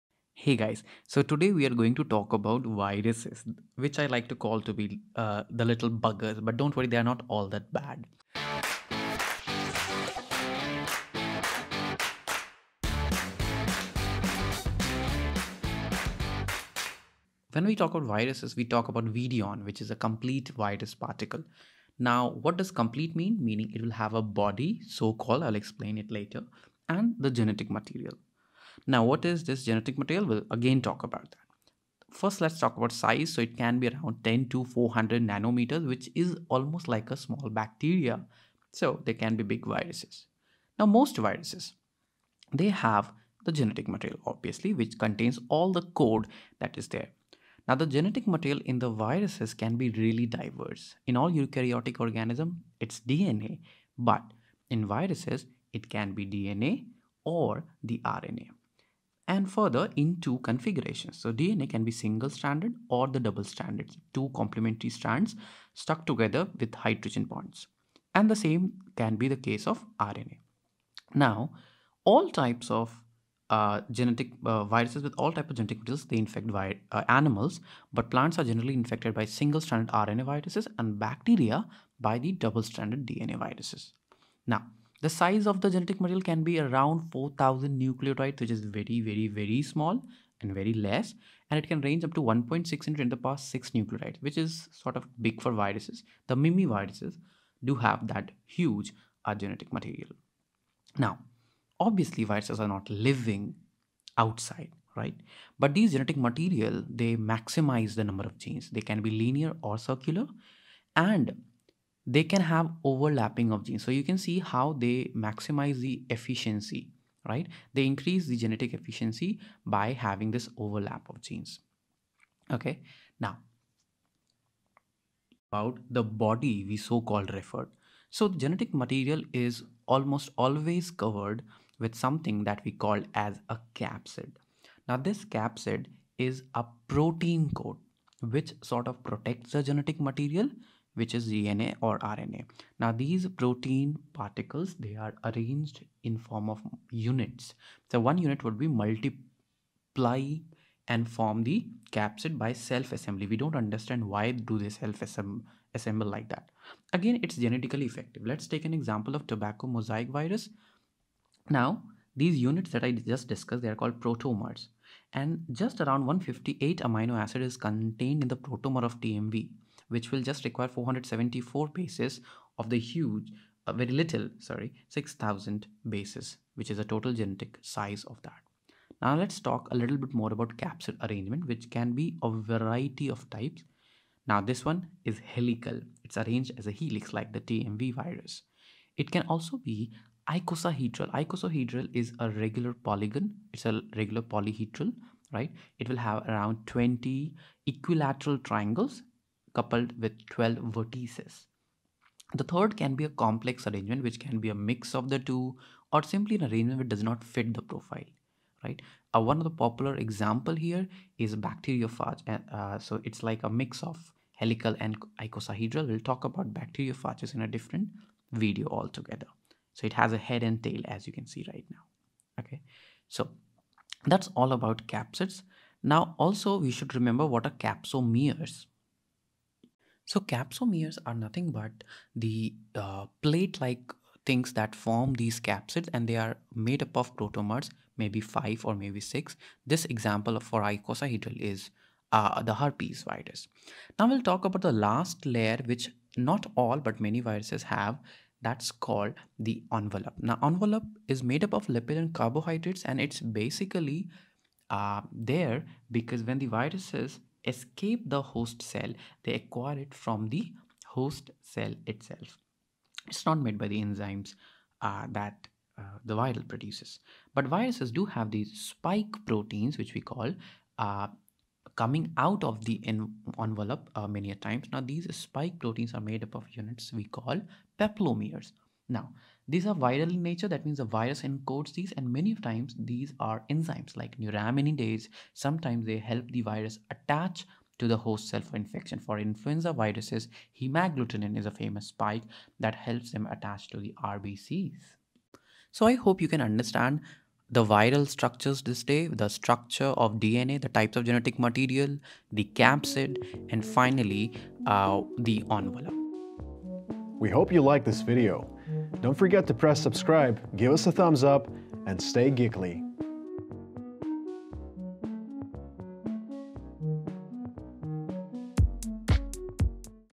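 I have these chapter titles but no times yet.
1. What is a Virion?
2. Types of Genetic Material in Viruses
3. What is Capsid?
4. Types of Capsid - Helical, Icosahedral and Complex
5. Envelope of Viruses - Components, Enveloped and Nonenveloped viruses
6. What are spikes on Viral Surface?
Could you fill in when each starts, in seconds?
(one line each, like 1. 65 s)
1. 20 s
2. 48 s
3. 130 s
4. 178 s
5. 246 s
6. 261 s.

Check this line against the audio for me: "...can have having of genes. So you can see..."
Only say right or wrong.
wrong.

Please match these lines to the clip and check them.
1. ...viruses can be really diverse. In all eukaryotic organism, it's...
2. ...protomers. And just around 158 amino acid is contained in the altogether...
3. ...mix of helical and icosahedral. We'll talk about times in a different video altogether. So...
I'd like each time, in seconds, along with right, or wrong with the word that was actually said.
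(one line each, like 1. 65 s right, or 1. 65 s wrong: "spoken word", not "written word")
1. 48 s right
2. 164 s wrong: "protomer", not "altogether"
3. 213 s wrong: "bacteriophages", not "times".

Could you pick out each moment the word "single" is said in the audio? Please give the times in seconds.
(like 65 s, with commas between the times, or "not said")
61 s, 79 s.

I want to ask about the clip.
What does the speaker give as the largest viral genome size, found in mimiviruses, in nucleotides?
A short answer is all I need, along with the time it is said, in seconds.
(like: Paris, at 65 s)
1.6 x 10^6 nucleotides, at 92 s.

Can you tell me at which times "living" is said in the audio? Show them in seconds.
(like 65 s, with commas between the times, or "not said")
102 s.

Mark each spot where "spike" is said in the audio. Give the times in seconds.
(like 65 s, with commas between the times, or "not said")
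268 s, 275 s, 291 s.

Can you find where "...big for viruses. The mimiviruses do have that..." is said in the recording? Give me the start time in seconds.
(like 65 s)
95 s.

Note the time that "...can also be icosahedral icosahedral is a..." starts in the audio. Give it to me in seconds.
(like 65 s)
189 s.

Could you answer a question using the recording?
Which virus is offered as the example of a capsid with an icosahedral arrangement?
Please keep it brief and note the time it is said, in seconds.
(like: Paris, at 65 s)
herpes virus, at 242 s.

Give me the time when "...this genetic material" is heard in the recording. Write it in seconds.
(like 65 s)
29 s.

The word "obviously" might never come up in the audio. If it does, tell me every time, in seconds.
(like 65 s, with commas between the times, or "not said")
44 s, 101 s.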